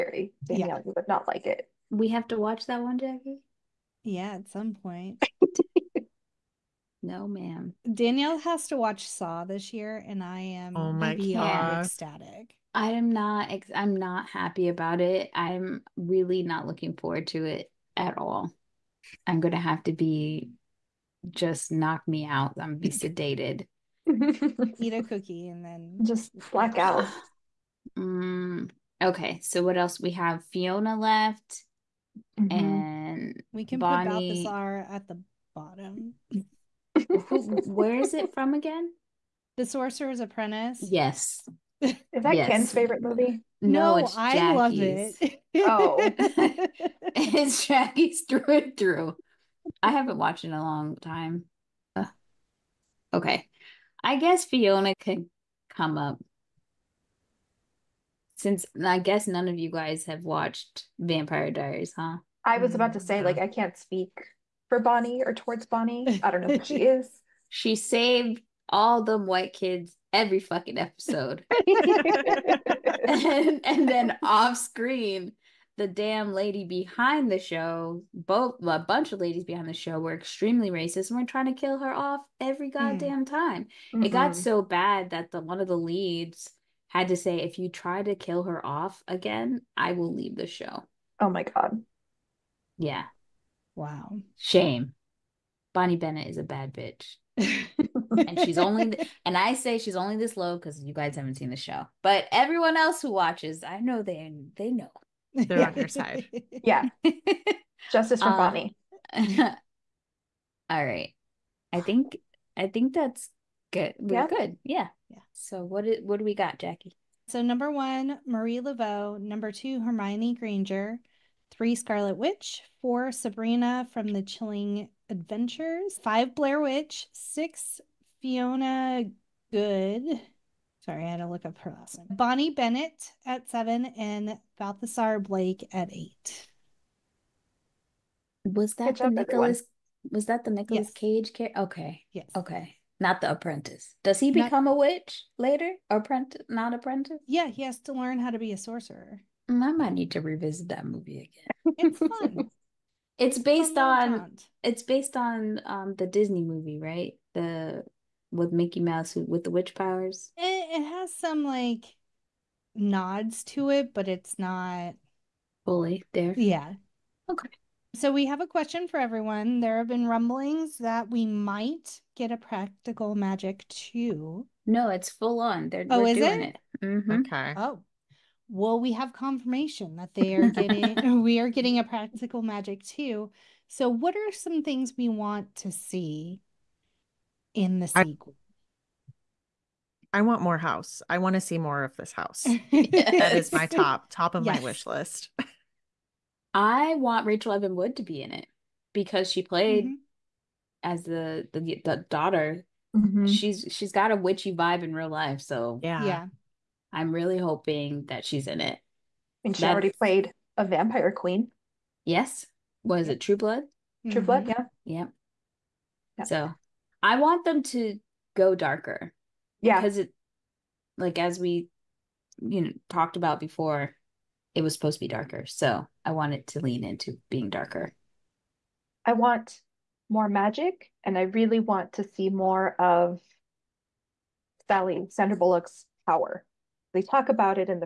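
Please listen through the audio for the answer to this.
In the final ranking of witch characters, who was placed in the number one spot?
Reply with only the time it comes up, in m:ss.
1:58.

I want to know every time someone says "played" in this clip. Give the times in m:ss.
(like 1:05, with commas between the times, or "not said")
3:19, 3:29.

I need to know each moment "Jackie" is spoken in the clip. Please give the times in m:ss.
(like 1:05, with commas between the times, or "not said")
0:02, 0:47, 1:56.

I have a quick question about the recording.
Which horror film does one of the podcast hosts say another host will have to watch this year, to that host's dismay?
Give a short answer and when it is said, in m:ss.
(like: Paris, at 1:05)
Saw, at 0:09.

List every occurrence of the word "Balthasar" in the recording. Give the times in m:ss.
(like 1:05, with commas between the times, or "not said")
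0:34, 2:14.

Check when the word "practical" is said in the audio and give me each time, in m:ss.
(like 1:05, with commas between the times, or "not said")
2:52, 3:01.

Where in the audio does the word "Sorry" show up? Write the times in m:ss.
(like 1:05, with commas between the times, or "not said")
2:10.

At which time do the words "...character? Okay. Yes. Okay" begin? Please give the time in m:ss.
2:21.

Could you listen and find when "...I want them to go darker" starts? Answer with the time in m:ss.
3:37.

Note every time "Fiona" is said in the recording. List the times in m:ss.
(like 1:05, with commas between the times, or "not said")
0:30, 0:54, 2:08.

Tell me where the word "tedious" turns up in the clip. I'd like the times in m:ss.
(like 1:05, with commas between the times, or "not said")
not said.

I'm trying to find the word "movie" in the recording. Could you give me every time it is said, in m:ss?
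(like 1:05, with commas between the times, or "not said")
0:43, 2:30, 2:36.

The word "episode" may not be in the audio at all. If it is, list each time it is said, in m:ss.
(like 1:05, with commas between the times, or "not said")
1:10.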